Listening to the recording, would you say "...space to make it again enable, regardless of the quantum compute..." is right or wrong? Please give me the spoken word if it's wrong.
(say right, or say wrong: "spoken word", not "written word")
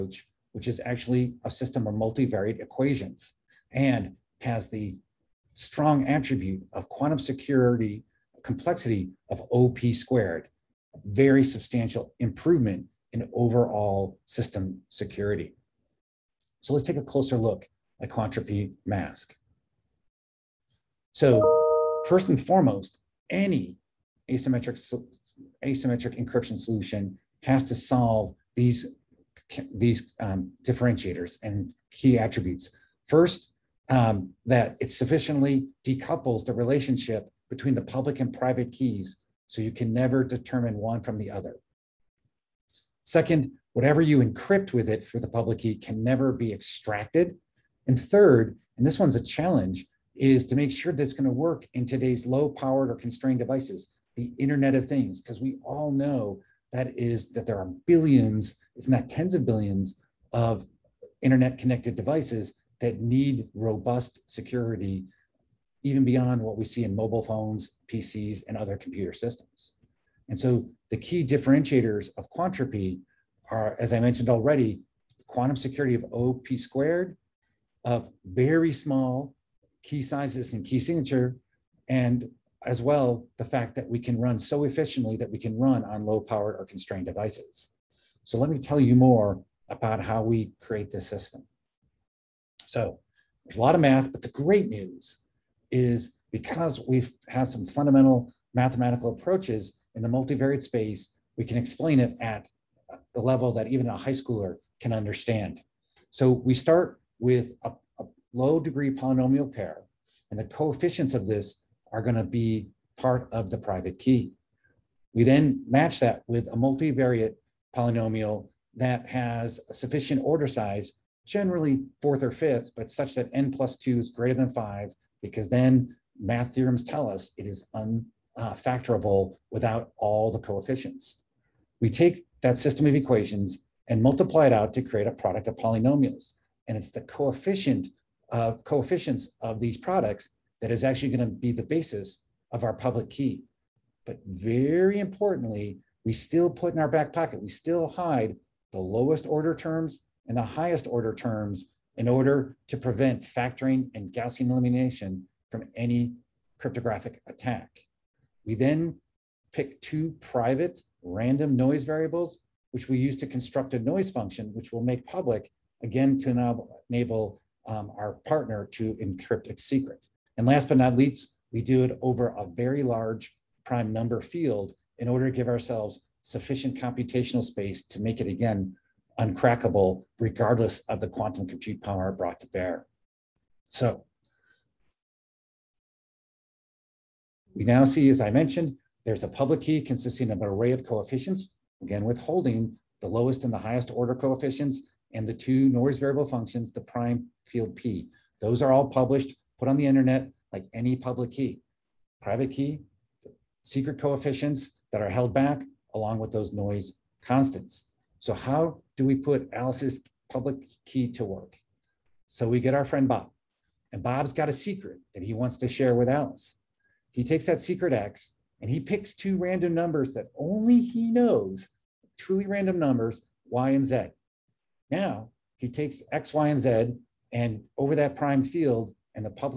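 wrong: "uncrackable", not "enable".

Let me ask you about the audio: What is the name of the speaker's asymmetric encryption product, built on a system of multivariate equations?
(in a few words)
Quantropi MASQ.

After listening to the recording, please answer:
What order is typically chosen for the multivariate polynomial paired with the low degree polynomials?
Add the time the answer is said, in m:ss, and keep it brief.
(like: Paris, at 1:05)
fourth or fifth, at 2:02.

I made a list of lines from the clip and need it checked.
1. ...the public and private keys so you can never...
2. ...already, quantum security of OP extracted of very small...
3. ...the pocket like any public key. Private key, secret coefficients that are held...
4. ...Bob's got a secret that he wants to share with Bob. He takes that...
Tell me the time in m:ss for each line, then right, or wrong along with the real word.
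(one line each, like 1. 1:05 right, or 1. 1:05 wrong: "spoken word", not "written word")
1. 0:37 right
2. 1:14 wrong: "squared", not "extracted"
3. 3:19 wrong: "internet", not "pocket"
4. 3:34 wrong: "Alice", not "Bob".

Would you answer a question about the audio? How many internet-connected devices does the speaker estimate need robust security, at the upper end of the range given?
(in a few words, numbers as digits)
tens of billions.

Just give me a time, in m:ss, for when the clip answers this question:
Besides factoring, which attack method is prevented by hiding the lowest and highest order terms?
2:34.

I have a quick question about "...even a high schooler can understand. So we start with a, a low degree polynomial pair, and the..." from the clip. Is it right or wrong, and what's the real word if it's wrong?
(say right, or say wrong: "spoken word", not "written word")
right.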